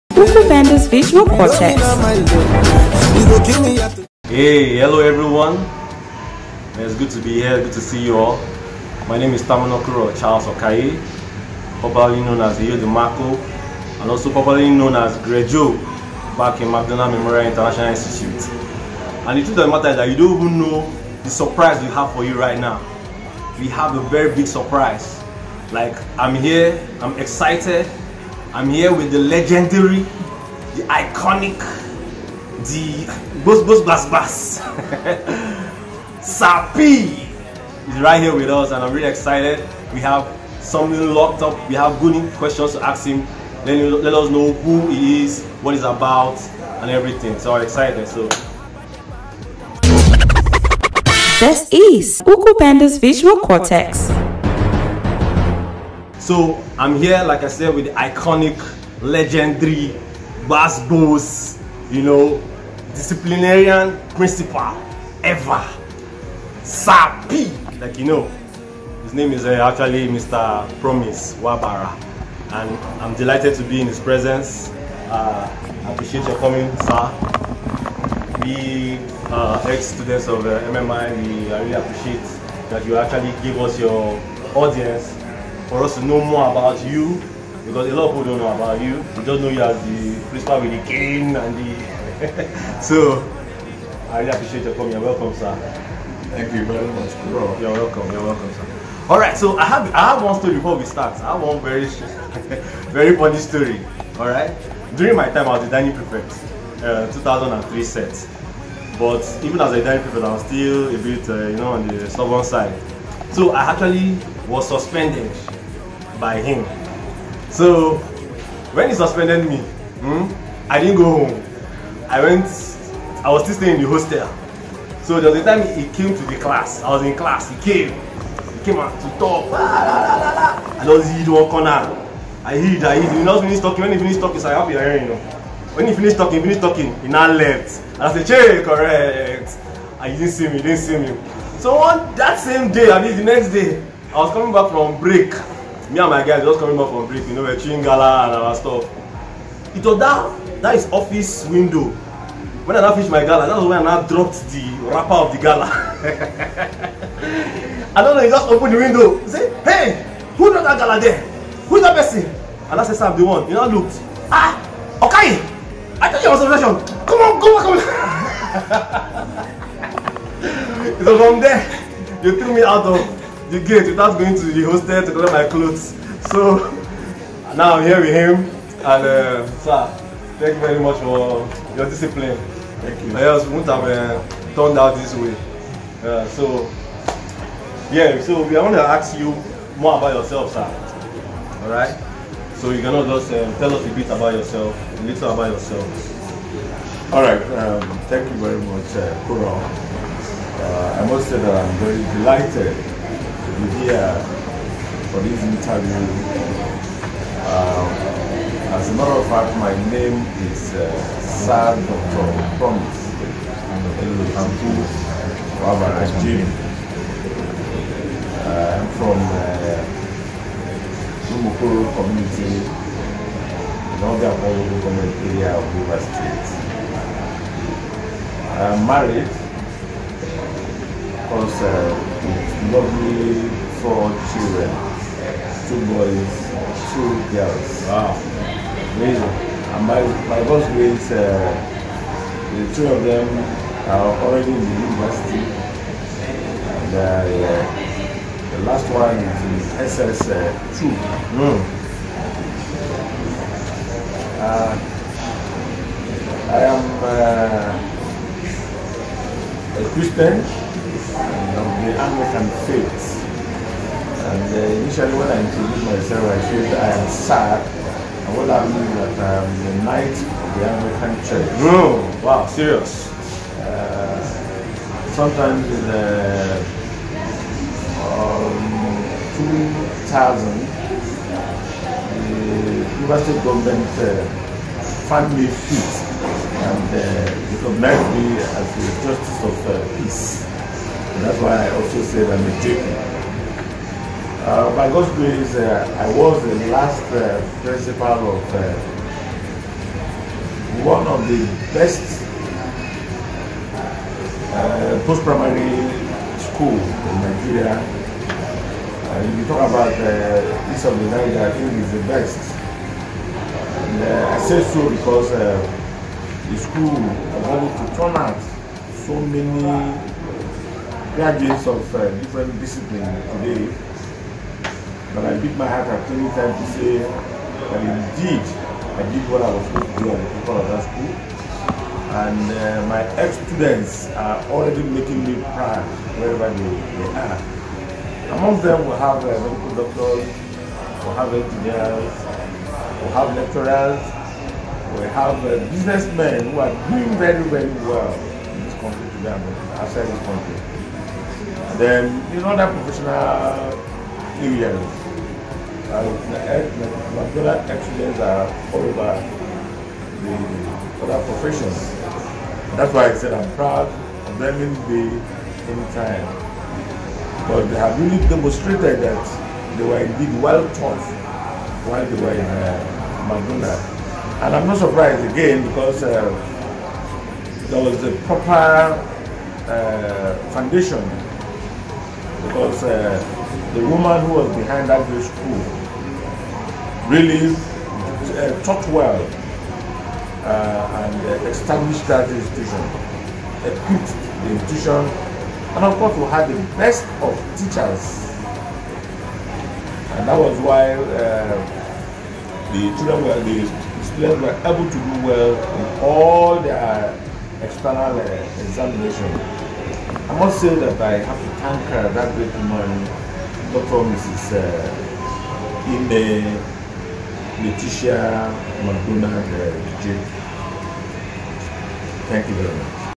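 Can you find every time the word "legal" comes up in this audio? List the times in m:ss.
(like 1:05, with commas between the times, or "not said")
not said.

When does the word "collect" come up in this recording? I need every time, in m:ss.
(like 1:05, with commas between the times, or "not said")
2:55.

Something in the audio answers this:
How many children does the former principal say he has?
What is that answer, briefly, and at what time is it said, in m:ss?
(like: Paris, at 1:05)
4, at 3:53.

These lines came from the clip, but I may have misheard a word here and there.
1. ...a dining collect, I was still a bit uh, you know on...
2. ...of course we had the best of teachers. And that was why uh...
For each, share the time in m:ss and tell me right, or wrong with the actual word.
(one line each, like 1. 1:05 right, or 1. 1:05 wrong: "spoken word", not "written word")
1. 1:49 wrong: "prefect", not "collect"
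2. 6:35 right.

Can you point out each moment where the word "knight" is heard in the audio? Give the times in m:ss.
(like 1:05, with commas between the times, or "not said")
4:29.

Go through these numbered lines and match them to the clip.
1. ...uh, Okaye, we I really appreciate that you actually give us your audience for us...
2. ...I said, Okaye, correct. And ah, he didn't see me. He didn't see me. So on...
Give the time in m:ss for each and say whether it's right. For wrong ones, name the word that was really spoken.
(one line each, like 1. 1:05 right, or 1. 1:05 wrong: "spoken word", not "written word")
1. 1:20 wrong: "MMI", not "Okaye"
2. 2:18 wrong: "Che", not "Okaye".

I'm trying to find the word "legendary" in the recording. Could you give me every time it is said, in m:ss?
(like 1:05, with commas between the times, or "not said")
0:29, 0:59.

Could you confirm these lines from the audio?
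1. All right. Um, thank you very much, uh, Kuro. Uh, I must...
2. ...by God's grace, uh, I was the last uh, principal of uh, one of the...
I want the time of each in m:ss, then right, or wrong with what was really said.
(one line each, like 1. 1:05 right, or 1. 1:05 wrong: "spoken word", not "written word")
1. 3:17 right
2. 4:54 right.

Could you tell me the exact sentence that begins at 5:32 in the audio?
And uh, my ex-students are already making me proud wherever they, they are.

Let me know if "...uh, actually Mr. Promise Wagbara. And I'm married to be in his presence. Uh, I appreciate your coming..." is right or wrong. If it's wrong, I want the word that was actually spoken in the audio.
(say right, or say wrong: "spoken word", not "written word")
wrong: "delighted", not "married".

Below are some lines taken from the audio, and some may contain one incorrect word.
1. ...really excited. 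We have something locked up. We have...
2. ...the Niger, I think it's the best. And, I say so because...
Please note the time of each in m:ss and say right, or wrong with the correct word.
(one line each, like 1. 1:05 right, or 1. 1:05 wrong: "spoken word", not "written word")
1. 0:38 right
2. 5:10 right.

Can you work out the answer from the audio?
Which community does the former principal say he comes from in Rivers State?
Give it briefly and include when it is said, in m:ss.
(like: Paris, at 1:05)
Lumukuru, at 3:41.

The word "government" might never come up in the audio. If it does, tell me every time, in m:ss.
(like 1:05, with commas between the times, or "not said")
3:44, 4:43.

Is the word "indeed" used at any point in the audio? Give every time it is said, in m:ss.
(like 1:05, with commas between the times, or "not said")
5:27, 6:09.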